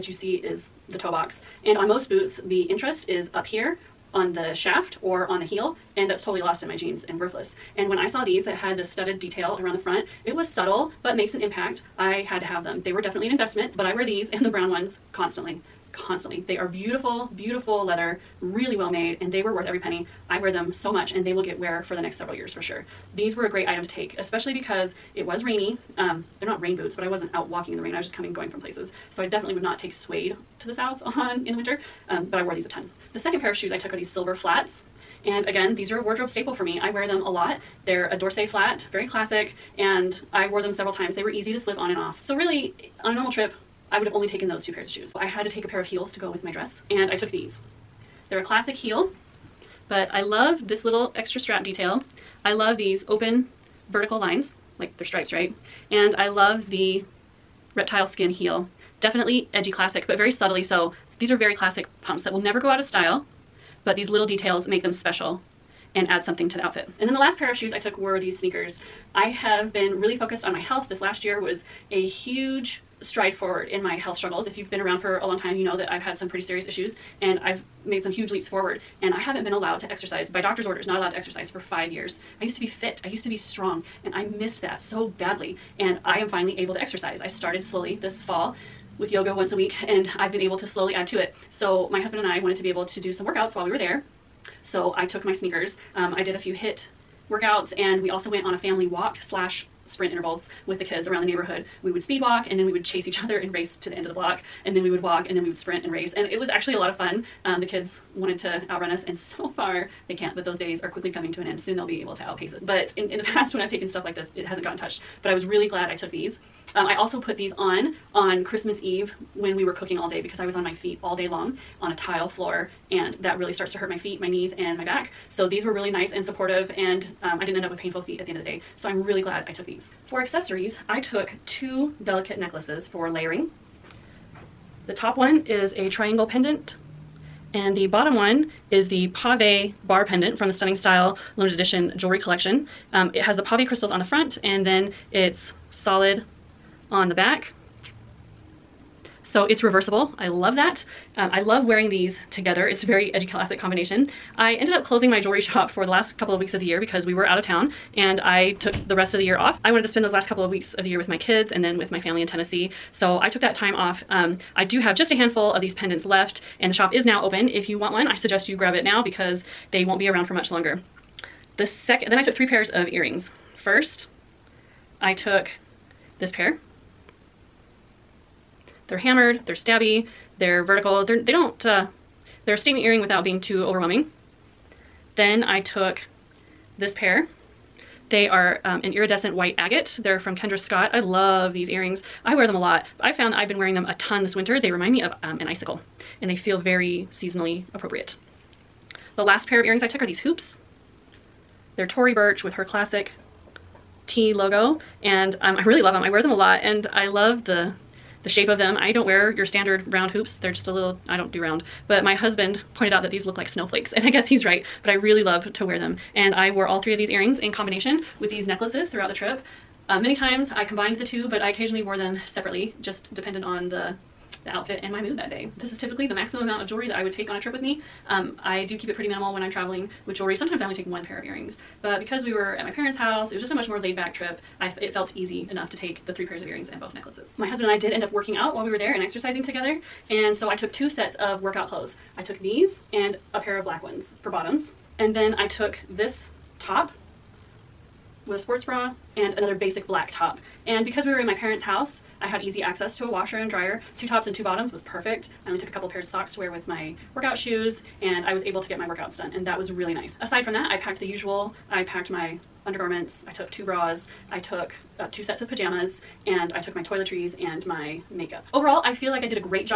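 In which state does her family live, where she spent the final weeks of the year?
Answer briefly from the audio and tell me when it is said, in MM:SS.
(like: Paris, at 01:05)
Tennessee, at 02:42.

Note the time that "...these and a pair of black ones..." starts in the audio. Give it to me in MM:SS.
04:02.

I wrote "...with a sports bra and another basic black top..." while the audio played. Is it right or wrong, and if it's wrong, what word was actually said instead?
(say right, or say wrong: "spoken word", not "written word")
right.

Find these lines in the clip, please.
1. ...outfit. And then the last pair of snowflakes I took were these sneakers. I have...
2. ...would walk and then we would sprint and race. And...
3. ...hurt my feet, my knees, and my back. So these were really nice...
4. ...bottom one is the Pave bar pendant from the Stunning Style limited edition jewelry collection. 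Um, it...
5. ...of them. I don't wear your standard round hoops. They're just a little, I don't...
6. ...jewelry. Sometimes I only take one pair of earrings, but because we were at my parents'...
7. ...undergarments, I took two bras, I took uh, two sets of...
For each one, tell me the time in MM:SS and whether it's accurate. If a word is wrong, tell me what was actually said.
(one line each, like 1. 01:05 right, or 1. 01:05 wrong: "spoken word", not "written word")
1. 01:06 wrong: "shoes", not "snowflakes"
2. 01:44 right
3. 02:03 right
4. 02:17 right
5. 03:28 right
6. 03:50 right
7. 04:22 right.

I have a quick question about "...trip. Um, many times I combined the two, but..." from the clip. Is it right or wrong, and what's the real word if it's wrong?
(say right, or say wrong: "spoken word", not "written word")
right.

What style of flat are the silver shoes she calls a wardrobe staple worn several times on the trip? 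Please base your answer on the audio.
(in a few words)
d'Orsay.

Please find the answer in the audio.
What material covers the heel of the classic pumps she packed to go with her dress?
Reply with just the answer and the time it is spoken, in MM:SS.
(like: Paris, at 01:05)
reptile skin, at 00:57.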